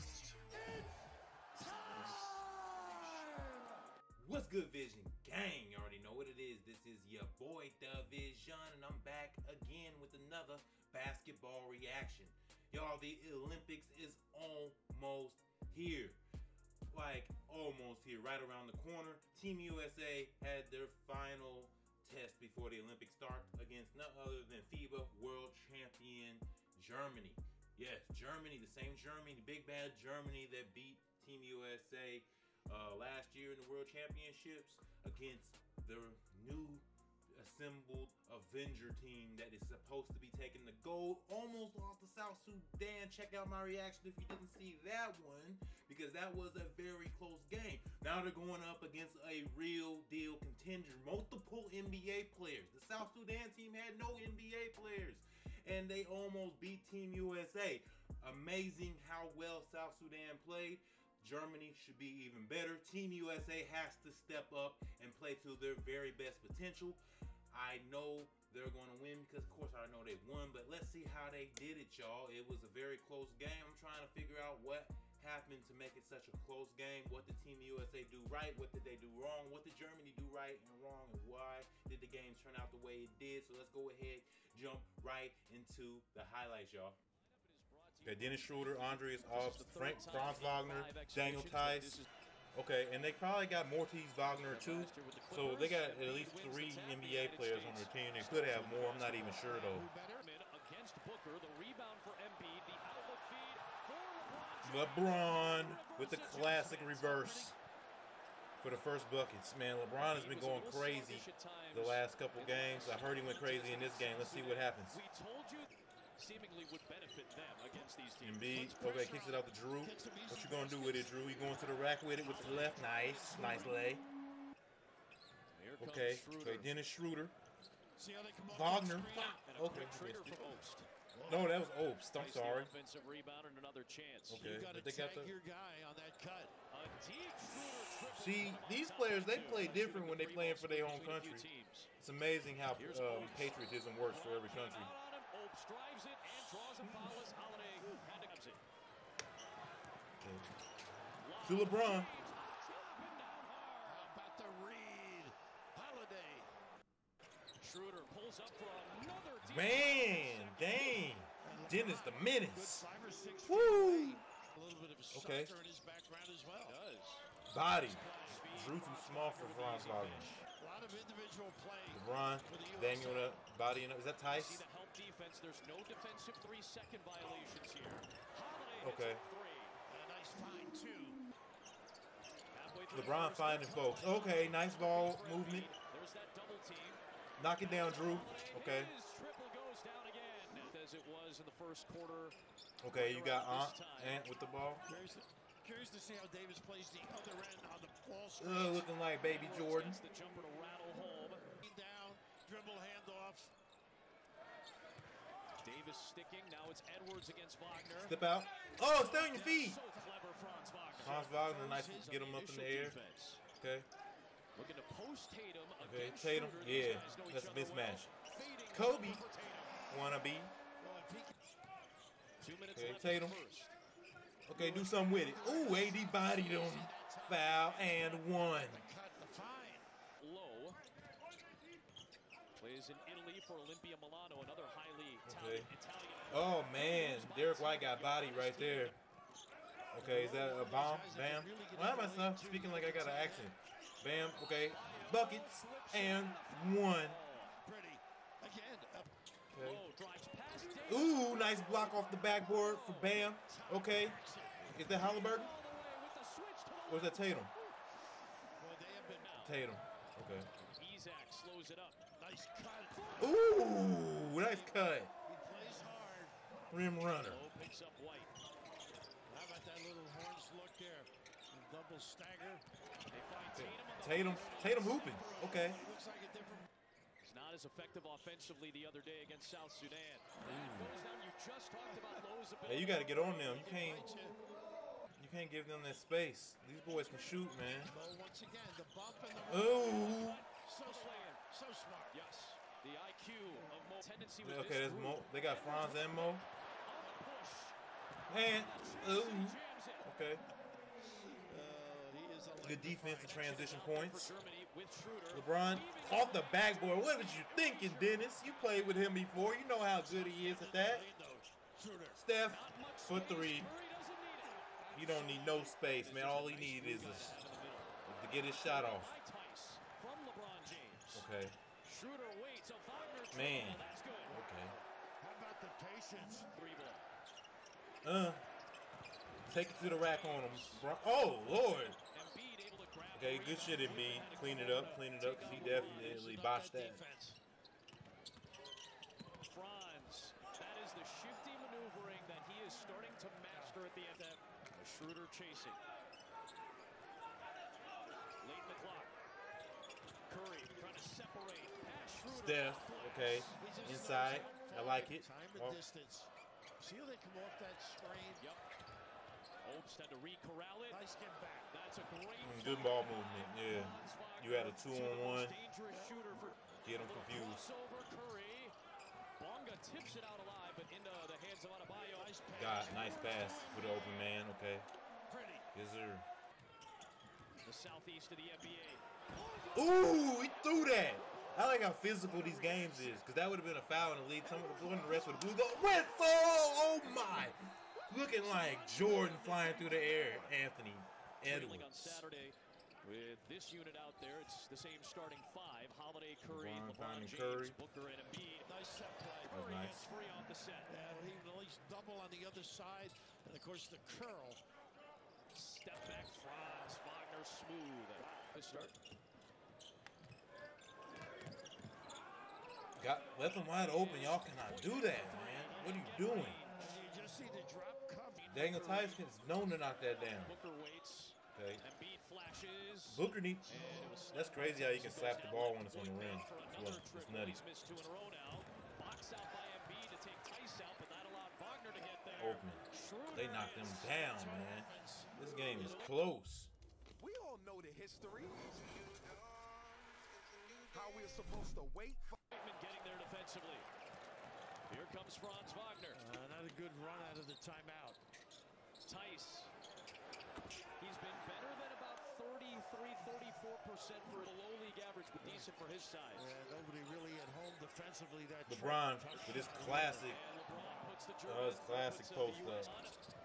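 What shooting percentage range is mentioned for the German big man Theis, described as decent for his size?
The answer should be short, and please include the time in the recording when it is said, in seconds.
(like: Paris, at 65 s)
33 to 34%, at 452 s.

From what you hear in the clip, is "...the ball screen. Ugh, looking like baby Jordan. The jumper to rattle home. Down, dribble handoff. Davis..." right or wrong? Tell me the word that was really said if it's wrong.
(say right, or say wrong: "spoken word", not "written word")
right.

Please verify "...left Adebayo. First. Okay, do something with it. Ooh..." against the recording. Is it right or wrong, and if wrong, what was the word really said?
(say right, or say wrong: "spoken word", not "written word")
wrong: "Tatum", not "Adebayo".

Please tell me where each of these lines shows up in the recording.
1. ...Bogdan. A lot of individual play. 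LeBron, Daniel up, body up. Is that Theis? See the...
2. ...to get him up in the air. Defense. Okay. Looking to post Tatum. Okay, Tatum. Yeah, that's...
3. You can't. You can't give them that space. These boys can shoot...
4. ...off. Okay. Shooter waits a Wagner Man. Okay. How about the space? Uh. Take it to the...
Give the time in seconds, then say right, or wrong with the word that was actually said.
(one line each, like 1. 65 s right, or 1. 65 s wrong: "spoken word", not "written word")
1. 169 s right
2. 212 s right
3. 283 s right
4. 318 s wrong: "patience", not "space".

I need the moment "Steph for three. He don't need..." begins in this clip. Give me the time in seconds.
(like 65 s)
312 s.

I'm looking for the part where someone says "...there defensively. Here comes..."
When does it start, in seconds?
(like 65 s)
443 s.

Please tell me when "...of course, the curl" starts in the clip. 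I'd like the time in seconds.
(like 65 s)
403 s.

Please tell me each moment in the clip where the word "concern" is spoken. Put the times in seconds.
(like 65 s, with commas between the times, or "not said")
not said.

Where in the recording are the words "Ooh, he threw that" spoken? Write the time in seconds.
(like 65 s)
379 s.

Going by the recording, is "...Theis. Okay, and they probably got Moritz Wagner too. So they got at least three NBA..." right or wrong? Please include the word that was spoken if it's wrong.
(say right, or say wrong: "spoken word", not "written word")
right.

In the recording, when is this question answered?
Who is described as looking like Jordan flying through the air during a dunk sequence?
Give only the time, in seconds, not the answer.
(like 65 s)
390 s.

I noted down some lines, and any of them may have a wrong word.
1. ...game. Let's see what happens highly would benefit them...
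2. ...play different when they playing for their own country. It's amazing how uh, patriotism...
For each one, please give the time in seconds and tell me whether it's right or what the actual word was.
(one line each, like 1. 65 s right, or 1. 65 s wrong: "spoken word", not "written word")
1. 113 s wrong: "seemingly", not "highly"
2. 139 s right.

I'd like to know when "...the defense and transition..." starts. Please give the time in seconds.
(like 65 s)
302 s.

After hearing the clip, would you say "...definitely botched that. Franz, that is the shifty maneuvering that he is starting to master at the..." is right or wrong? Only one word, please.
right.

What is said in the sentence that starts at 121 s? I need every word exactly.
You going to the rack with it with the left?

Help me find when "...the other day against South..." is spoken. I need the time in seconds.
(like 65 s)
278 s.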